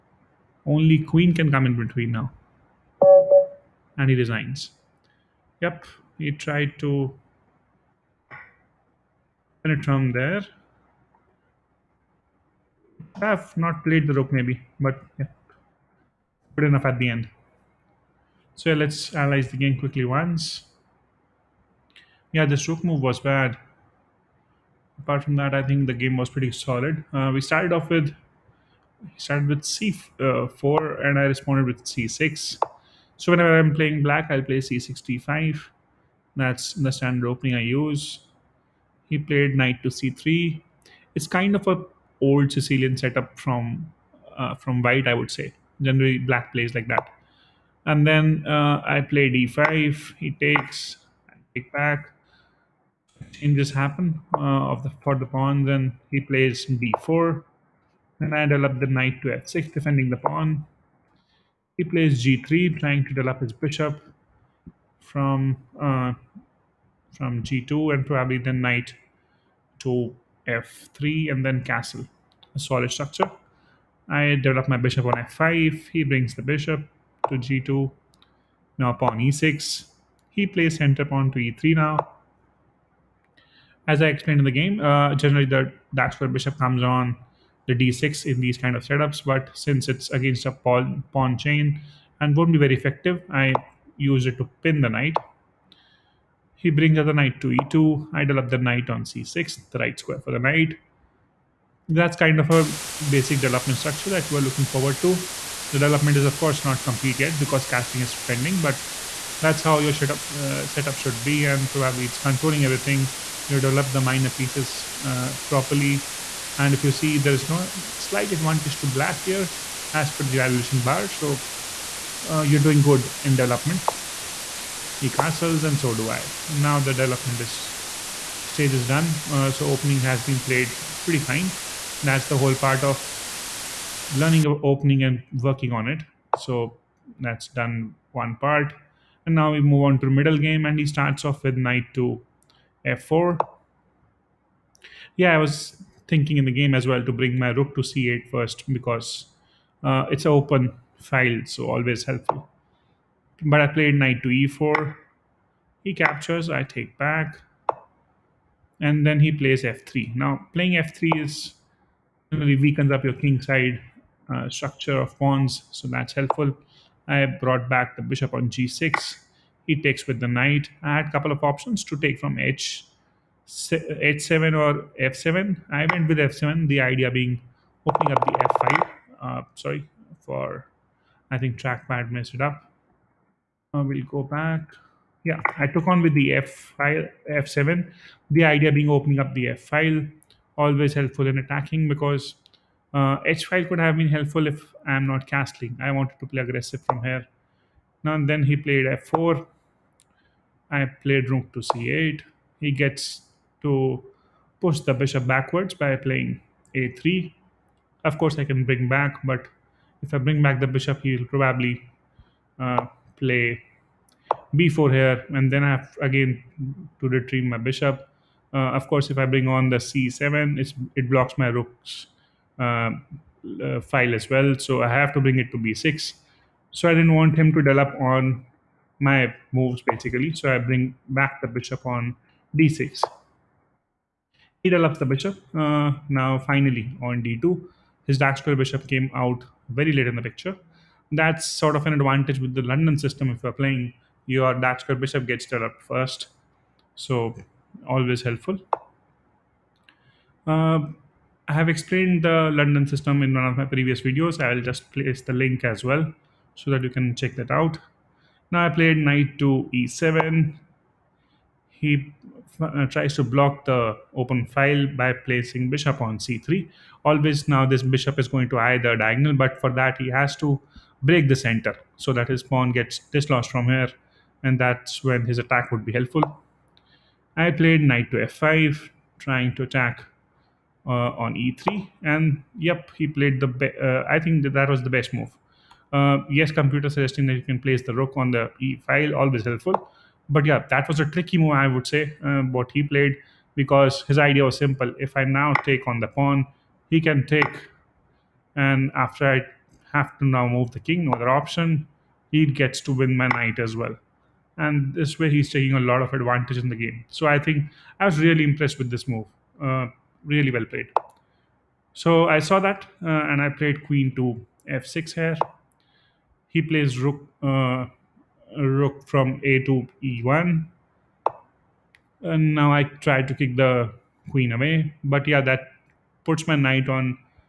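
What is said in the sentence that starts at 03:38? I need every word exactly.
Uh, of course, if I bring on the c7, it blocks my rook's uh, uh, file as well.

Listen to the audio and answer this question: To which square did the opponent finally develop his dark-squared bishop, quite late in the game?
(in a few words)
d2.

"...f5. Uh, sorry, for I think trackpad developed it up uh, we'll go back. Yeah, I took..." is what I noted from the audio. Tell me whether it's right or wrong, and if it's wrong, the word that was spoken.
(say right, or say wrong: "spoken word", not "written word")
wrong: "messed", not "developed".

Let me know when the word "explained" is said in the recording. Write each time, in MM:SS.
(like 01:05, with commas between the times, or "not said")
01:24, 04:11.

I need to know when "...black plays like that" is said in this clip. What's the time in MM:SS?
00:46.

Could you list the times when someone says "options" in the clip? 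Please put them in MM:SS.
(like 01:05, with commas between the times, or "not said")
02:51, 05:01.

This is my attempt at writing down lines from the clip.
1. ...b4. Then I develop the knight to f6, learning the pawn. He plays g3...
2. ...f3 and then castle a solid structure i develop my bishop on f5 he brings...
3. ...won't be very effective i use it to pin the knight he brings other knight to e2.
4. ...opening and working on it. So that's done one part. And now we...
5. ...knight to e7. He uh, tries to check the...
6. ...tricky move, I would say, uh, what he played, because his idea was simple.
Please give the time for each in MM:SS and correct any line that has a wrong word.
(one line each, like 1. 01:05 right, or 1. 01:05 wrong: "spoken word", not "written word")
1. 00:56 wrong: "defending", not "learning"
2. 01:10 right
3. 01:32 right
4. 02:14 right
5. 04:18 wrong: "block", not "check"
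6. 04:51 right.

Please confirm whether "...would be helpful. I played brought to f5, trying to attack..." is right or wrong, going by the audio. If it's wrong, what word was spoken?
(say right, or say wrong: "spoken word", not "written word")
wrong: "knight", not "brought".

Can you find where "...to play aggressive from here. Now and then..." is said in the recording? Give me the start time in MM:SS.
03:16.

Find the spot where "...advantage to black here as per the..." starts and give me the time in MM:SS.
01:58.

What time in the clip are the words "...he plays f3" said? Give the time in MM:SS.
02:39.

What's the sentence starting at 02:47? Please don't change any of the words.
I brought back the bishop on g6.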